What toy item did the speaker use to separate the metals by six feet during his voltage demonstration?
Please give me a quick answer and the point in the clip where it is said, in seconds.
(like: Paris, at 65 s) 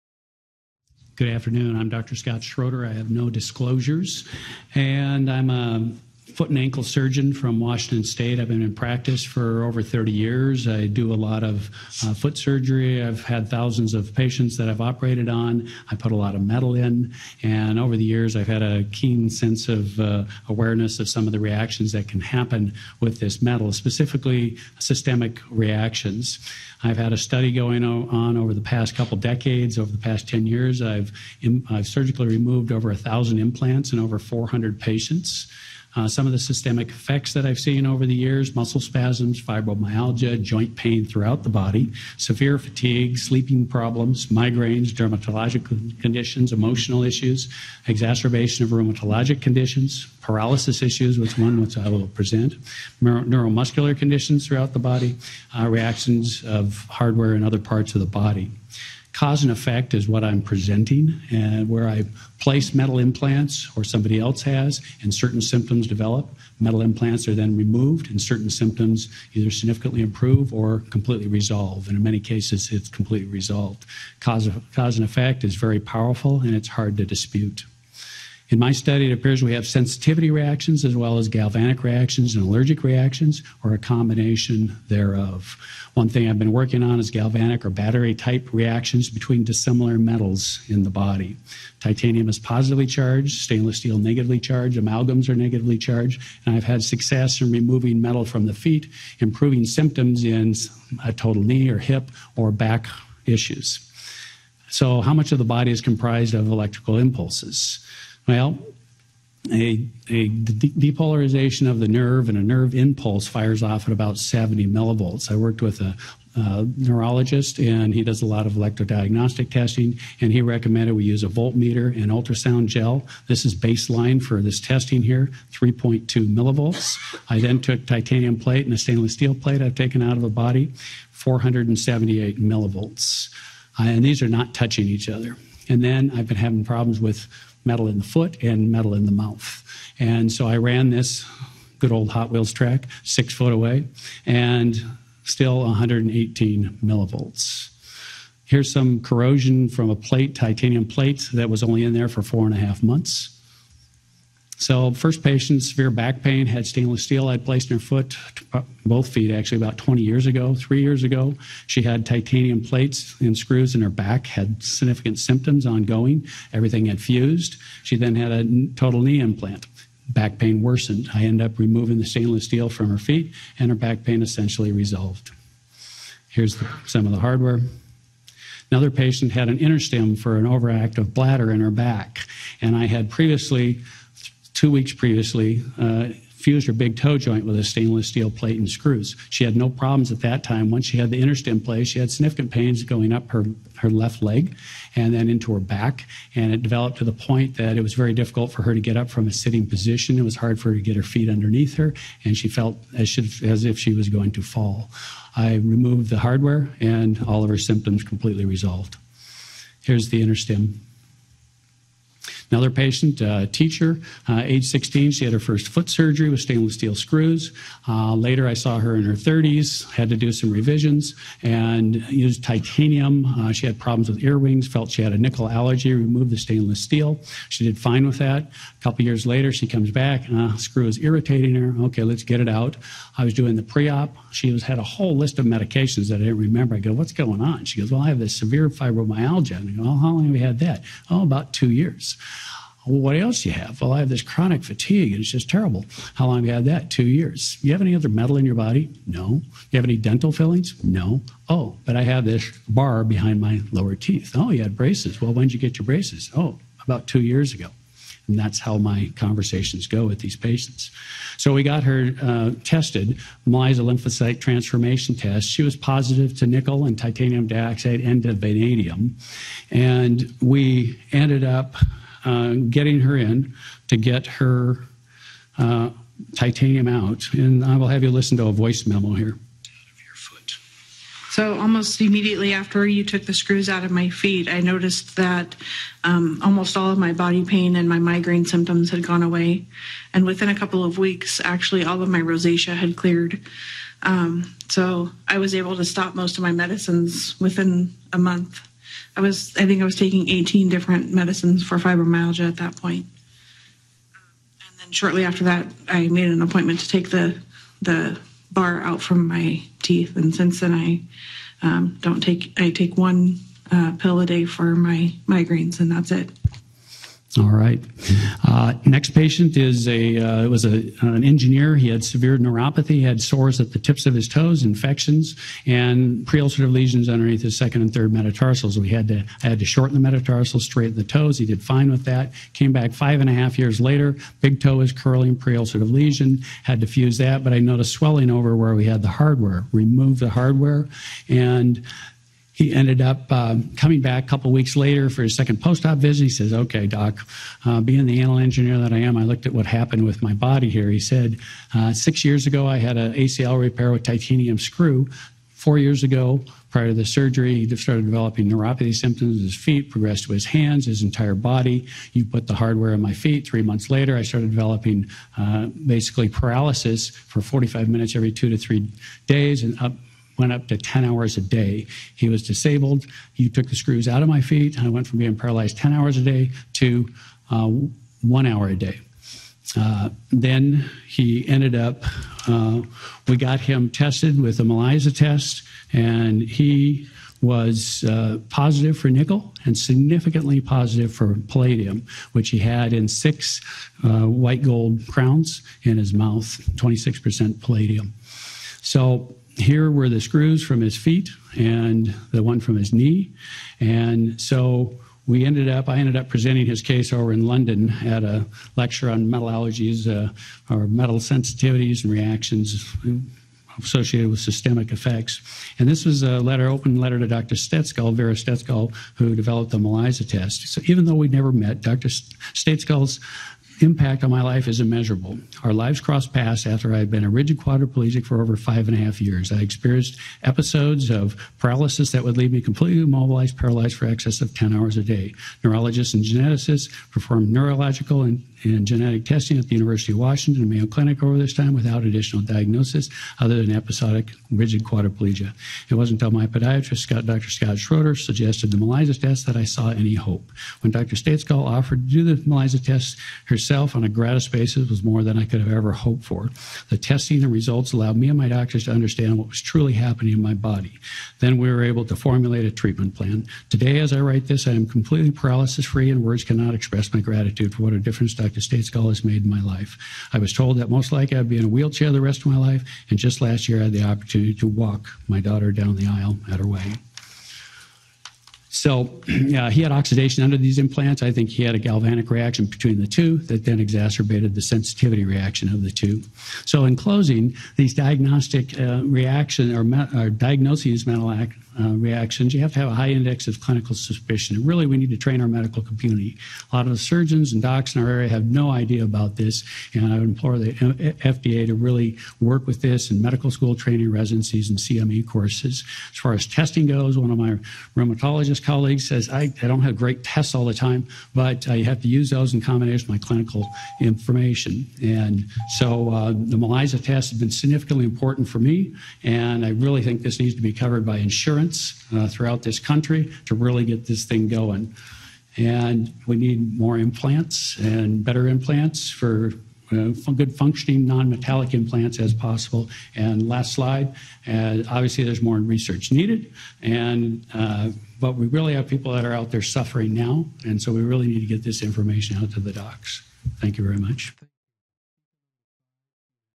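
Hot Wheels track, at 142 s.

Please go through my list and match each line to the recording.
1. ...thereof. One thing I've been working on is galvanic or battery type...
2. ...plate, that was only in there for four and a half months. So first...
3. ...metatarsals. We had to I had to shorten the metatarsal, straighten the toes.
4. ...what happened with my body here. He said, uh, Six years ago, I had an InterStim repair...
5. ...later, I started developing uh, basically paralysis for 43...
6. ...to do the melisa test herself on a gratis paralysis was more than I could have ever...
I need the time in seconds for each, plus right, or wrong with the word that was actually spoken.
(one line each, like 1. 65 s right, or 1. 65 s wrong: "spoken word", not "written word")
1. 84 s right
2. 150 s right
3. 328 s right
4. 349 s wrong: "ACL", not "InterStim"
5. 363 s wrong: "45", not "43"
6. 452 s wrong: "basis", not "paralysis".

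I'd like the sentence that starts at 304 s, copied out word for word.
And then shortly after that, I made an appointment to take the, the bar out from my teeth.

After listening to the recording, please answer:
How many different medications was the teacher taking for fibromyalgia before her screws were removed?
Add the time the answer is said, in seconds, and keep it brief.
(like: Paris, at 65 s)
18, at 300 s.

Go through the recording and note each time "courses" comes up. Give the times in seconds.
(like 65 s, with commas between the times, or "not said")
505 s.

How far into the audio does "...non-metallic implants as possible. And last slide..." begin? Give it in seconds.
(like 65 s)
531 s.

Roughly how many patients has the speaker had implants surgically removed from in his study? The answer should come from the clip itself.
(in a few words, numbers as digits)
over 400.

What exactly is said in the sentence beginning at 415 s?
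And this was a letter, open letter to Dr.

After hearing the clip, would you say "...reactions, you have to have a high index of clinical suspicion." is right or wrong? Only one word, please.
right.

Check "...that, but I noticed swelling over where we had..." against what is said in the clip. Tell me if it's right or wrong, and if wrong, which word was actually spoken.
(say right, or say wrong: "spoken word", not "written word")
right.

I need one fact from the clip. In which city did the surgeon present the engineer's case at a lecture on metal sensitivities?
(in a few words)
London.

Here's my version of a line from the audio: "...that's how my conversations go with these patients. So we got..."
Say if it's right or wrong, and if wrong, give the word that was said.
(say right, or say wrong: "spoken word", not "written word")
right.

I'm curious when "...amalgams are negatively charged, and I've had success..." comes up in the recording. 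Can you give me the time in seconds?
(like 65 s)
94 s.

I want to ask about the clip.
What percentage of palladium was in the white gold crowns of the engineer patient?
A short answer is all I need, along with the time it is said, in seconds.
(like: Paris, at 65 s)
26%, at 396 s.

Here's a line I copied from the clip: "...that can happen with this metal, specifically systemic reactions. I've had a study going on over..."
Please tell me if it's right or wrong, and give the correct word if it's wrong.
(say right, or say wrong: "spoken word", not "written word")
right.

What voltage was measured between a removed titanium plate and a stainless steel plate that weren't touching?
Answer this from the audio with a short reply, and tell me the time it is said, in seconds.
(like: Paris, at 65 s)
478 millivolts, at 131 s.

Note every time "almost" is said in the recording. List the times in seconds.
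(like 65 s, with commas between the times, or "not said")
281 s, 286 s.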